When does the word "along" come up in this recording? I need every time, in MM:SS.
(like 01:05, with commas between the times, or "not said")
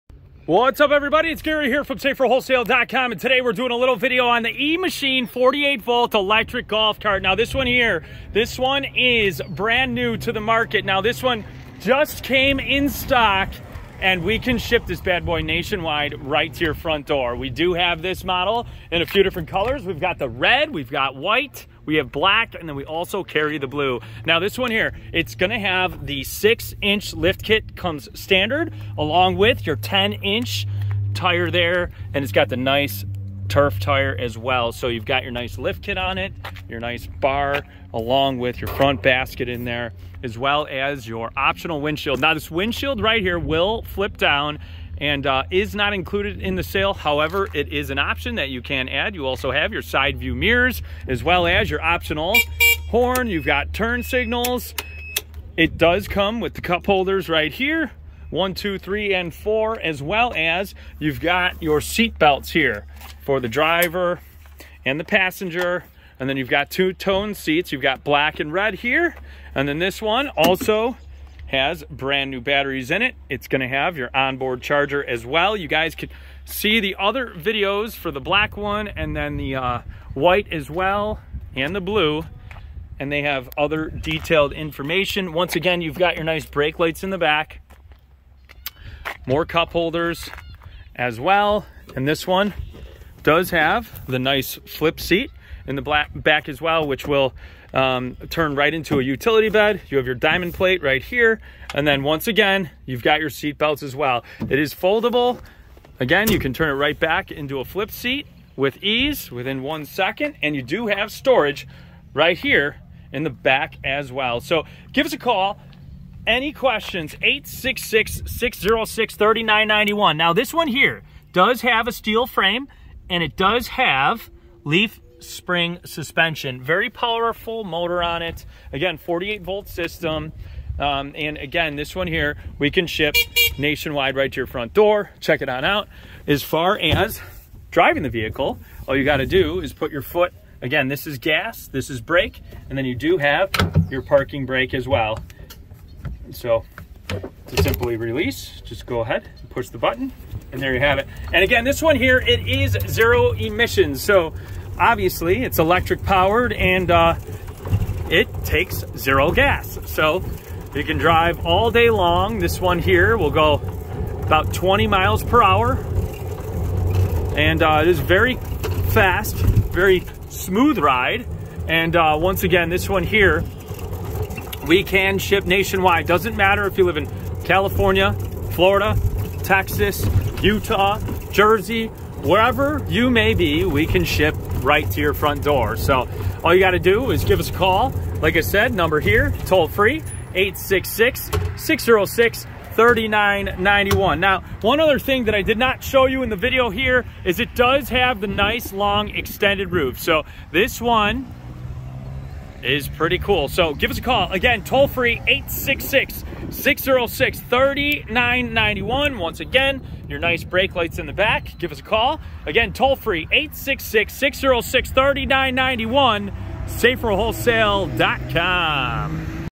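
00:28, 00:37.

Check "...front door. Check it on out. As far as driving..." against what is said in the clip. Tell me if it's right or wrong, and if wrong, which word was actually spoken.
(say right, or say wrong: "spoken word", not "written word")
right.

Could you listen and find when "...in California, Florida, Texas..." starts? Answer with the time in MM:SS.
02:56.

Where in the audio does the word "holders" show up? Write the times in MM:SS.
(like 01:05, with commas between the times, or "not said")
00:56, 01:29.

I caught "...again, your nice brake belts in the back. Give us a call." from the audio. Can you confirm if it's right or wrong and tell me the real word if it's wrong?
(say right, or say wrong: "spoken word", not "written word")
wrong: "lights", not "belts".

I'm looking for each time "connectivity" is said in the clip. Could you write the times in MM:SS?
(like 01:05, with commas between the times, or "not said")
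not said.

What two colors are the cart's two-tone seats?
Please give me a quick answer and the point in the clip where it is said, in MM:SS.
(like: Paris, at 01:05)
Black and red, at 01:08.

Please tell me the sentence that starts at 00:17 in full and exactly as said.
We do have this model in a few different colors.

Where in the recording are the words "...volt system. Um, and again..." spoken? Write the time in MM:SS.
02:09.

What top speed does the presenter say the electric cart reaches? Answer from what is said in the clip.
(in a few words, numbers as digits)
20 mph.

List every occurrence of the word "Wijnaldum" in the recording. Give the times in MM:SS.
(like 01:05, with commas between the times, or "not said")
not said.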